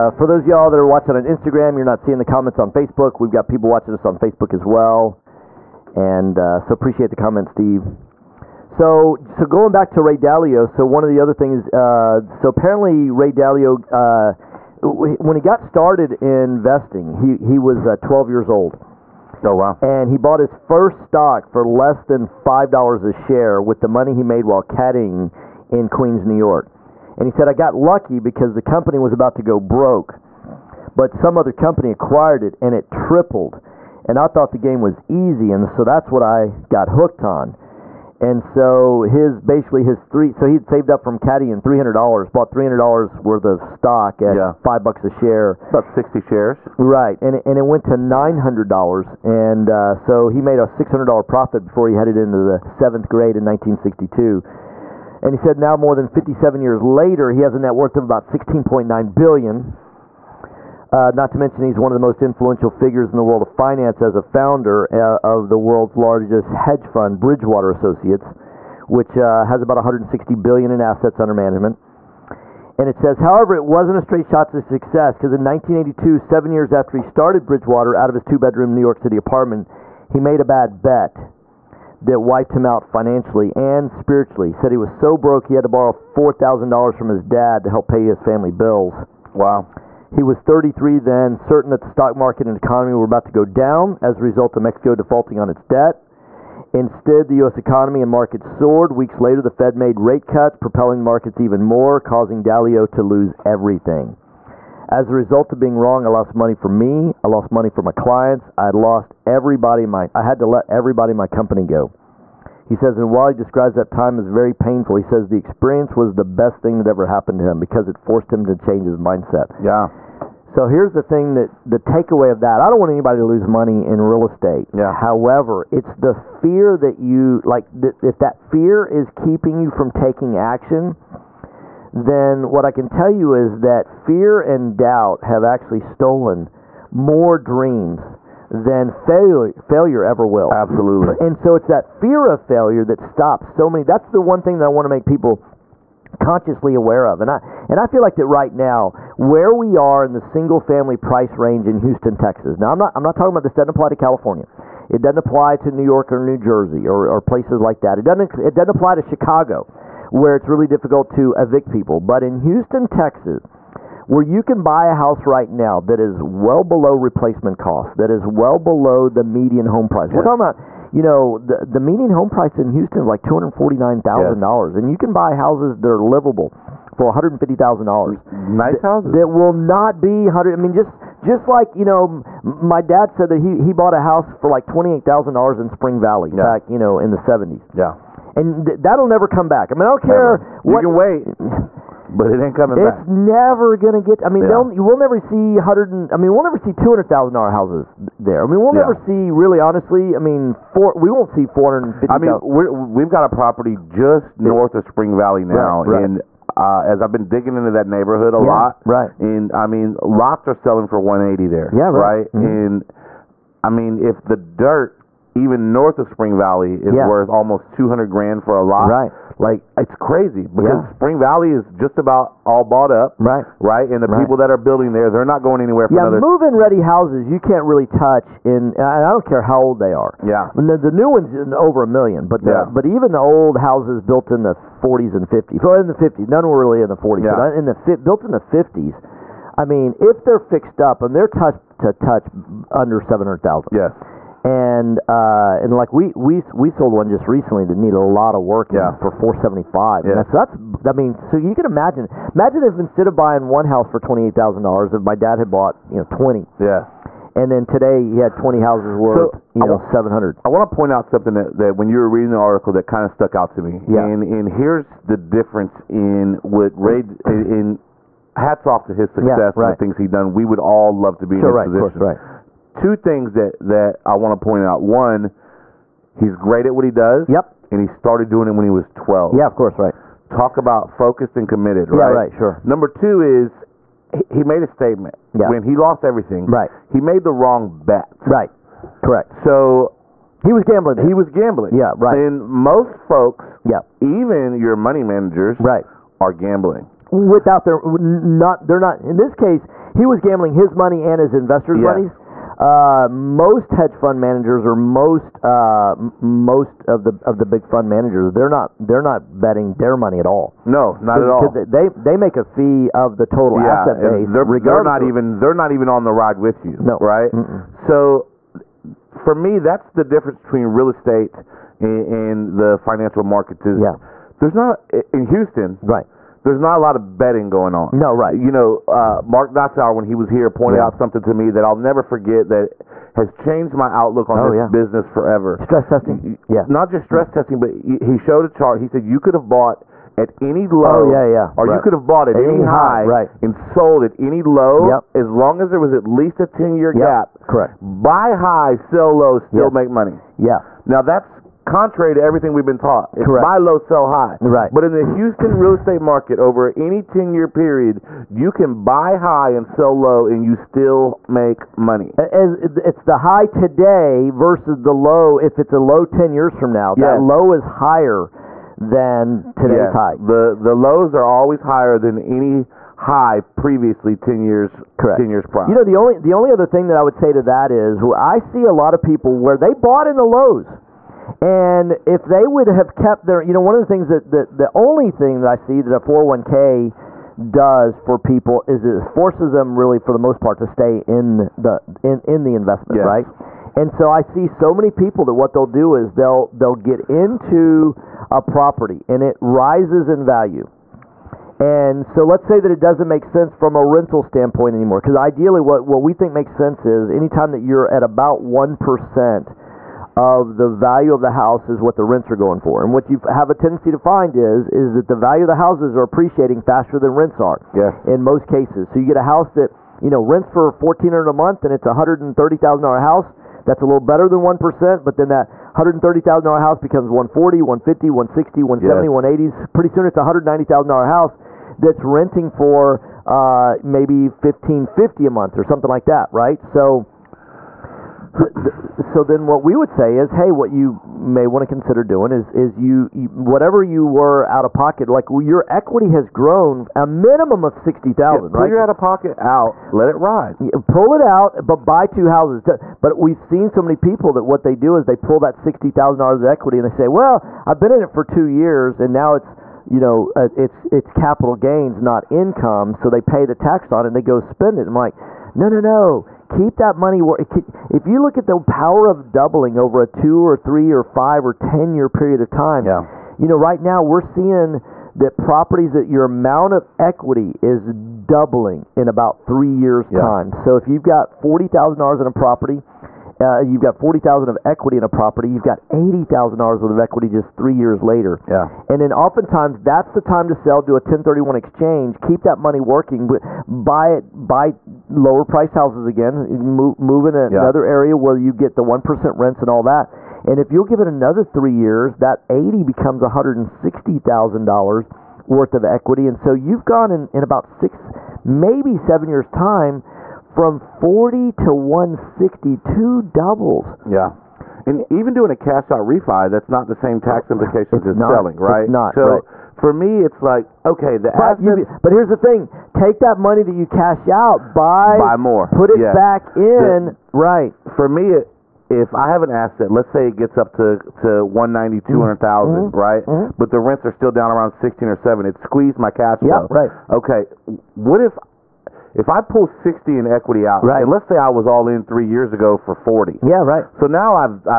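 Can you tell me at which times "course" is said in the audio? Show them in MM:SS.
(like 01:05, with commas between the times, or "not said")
04:32, 04:39.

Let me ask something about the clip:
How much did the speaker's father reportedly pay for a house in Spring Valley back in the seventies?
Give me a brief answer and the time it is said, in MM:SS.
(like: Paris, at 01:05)
$28,000, at 03:04.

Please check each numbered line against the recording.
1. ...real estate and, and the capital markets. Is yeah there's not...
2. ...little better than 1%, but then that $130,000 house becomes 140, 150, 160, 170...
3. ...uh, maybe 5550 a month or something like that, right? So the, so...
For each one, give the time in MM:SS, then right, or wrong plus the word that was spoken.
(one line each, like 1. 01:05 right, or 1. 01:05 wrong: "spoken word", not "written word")
1. 05:20 wrong: "financial", not "capital"
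2. 07:03 right
3. 07:13 wrong: "1550", not "5550".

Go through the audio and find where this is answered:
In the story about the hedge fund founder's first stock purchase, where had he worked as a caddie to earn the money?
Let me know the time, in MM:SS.
00:25.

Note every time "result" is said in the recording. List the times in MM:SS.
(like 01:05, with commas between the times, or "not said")
01:34, 01:45.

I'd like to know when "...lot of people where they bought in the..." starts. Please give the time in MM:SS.
06:18.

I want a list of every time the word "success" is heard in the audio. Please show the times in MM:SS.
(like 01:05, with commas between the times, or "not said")
01:14, 04:29.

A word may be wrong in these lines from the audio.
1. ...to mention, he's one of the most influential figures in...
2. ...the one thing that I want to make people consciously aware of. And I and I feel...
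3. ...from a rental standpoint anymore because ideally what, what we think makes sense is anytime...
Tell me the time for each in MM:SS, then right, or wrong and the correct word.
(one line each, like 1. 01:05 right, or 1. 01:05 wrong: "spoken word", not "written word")
1. 01:01 right
2. 02:24 right
3. 06:43 right.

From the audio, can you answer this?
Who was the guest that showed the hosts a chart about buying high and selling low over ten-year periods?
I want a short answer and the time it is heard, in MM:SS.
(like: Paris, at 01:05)
Mark Dotzauer, at 05:29.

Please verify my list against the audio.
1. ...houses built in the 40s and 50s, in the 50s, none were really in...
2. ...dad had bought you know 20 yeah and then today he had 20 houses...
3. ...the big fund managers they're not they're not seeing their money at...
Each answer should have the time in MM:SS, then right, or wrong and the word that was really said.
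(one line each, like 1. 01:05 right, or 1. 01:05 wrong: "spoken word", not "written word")
1. 03:53 right
2. 04:15 right
3. 05:07 wrong: "betting", not "seeing".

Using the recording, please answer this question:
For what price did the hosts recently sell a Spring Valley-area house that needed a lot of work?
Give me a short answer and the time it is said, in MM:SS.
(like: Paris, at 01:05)
$475,000, at 04:09.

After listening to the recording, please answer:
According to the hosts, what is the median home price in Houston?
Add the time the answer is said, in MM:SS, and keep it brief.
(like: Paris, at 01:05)
$249,000, at 02:53.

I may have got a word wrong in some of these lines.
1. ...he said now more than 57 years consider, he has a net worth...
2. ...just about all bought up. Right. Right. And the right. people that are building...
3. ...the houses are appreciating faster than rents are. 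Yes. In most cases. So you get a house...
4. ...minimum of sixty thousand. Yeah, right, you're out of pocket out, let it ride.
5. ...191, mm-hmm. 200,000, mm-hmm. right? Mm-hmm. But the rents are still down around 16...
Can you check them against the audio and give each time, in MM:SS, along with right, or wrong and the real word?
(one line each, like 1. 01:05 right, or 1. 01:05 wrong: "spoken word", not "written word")
1. 00:55 wrong: "later", not "consider"
2. 03:41 right
3. 06:55 right
4. 07:27 right
5. 08:51 wrong: "190", not "191".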